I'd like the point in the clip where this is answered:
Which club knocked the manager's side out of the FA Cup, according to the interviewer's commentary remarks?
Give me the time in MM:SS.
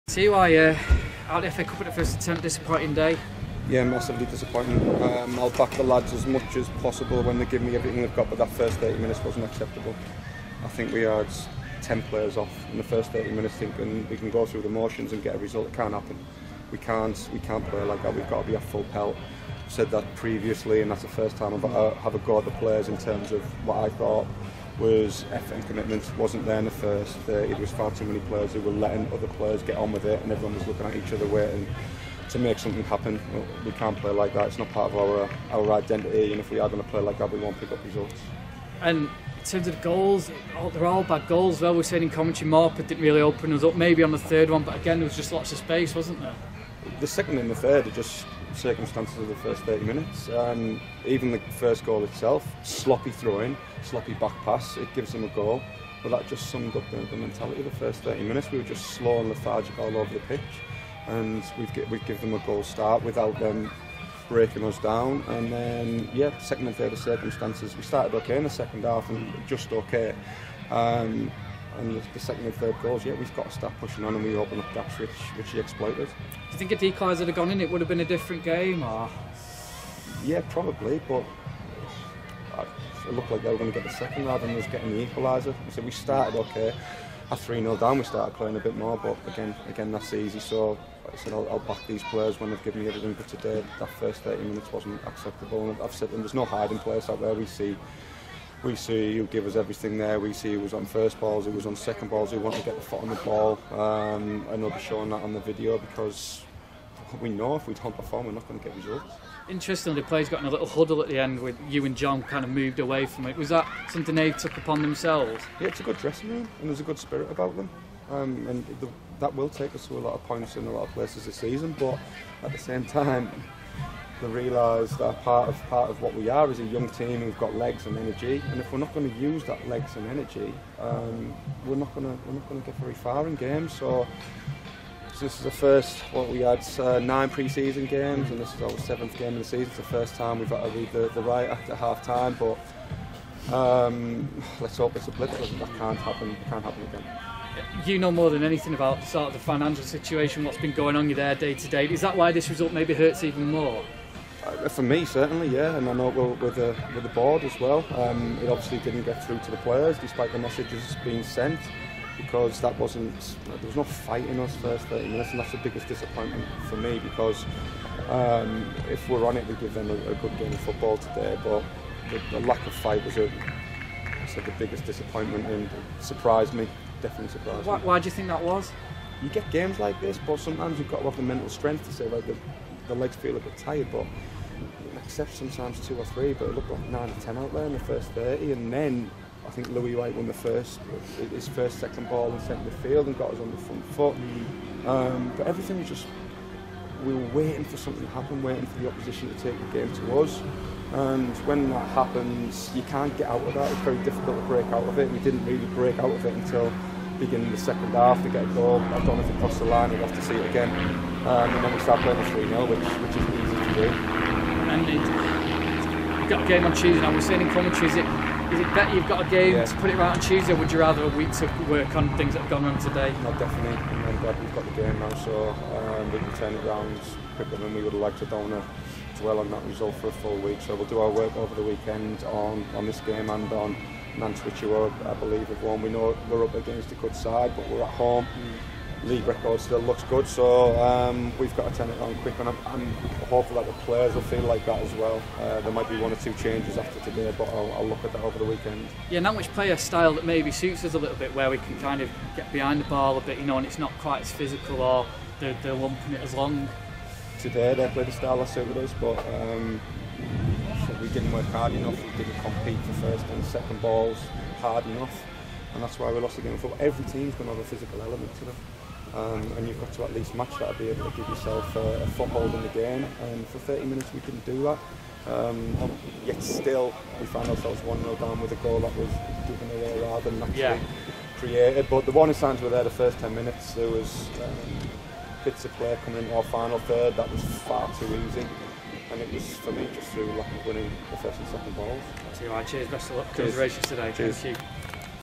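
00:42.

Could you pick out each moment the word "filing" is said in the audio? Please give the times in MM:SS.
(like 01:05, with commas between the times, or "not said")
not said.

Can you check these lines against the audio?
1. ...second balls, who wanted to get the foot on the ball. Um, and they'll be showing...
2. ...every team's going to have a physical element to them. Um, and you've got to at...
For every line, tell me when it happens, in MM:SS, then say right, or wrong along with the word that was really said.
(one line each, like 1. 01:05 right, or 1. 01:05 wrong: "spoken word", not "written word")
1. 01:41 right
2. 04:26 right.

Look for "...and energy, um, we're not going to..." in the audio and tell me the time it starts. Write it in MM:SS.
02:09.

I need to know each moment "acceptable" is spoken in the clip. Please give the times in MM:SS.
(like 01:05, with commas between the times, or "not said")
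00:09, 01:35.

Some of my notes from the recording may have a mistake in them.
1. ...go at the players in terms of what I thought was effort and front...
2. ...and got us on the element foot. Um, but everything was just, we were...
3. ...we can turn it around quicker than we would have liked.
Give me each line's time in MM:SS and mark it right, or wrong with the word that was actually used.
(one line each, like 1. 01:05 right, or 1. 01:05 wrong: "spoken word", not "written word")
1. 00:22 wrong: "commitment", not "front"
2. 03:13 wrong: "front", not "element"
3. 03:46 right.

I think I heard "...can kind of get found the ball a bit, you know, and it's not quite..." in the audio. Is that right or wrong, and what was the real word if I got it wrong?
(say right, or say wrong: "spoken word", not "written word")
wrong: "behind", not "found".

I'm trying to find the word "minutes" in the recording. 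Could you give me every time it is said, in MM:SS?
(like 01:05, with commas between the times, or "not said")
00:08, 00:13, 00:49, 00:58, 01:34, 02:45, 04:33, 04:43.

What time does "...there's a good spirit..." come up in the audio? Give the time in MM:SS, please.
01:56.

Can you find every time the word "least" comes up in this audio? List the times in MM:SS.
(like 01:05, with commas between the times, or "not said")
04:30.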